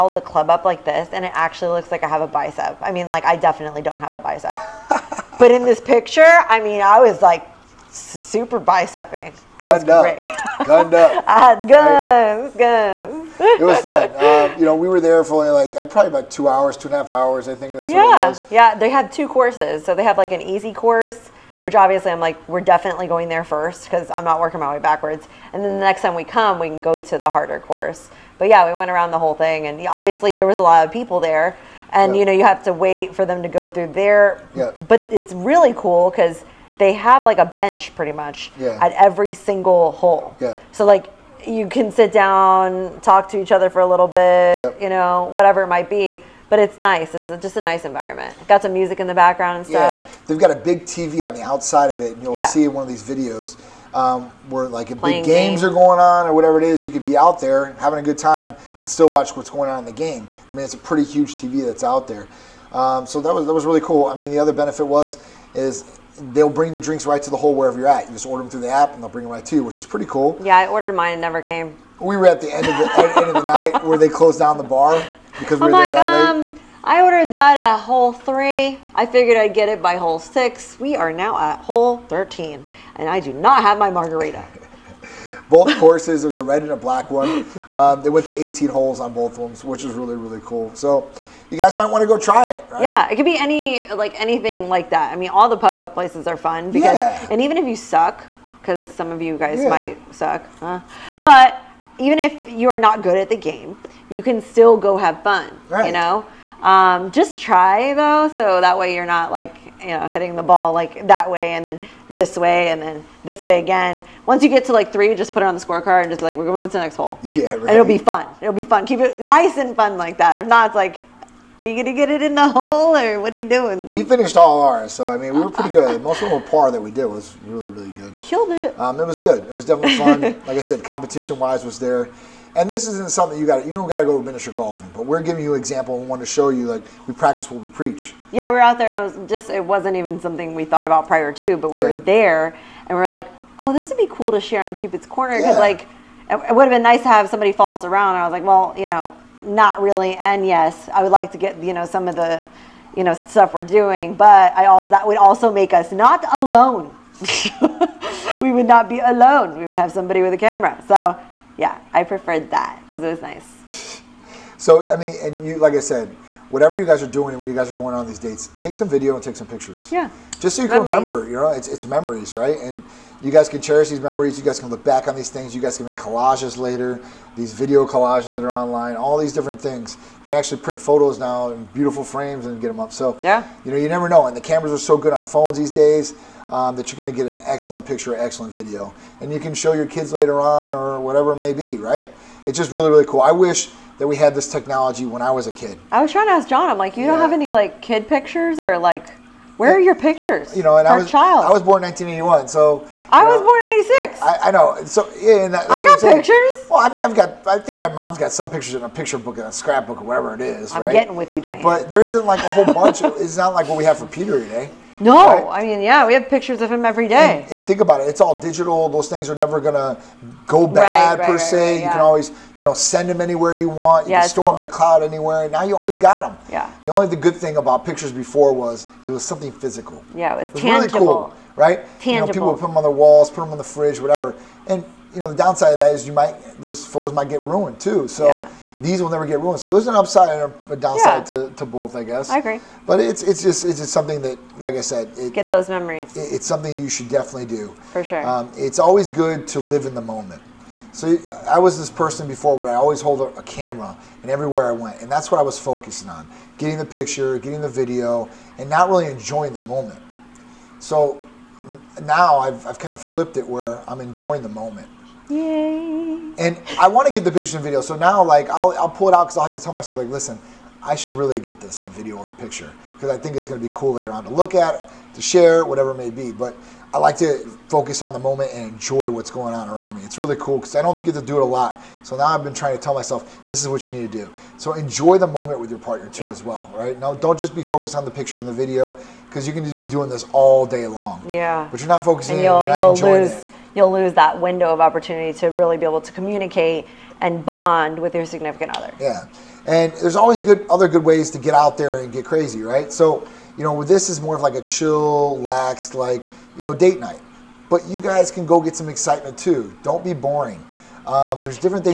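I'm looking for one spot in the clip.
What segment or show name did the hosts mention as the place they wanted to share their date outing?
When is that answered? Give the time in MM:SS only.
02:24.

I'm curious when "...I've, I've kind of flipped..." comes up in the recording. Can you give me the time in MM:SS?
04:22.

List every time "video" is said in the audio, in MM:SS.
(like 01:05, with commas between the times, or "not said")
00:53, 02:48, 02:57, 03:08, 04:17, 04:27, 04:31, 04:48.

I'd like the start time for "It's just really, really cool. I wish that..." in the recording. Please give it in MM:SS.
03:12.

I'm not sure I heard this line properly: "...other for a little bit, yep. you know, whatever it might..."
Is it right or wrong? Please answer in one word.
right.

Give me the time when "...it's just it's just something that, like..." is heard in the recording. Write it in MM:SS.
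04:03.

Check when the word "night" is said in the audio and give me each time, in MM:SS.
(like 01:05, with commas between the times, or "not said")
01:13, 05:06.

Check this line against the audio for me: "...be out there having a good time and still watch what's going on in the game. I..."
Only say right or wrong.
right.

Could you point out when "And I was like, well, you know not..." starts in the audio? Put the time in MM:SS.
02:28.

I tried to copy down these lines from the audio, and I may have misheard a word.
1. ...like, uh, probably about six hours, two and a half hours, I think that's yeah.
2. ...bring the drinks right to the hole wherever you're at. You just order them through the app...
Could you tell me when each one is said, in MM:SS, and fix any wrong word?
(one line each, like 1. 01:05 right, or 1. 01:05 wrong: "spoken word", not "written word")
1. 00:15 wrong: "two", not "six"
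2. 01:06 right.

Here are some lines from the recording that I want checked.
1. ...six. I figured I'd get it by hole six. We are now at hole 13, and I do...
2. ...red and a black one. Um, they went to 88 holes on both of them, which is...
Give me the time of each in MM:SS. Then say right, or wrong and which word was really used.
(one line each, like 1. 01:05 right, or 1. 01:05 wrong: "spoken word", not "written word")
1. 01:18 wrong: "three", not "six"
2. 01:26 wrong: "18", not "88".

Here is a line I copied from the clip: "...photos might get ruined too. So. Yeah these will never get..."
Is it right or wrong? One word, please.
right.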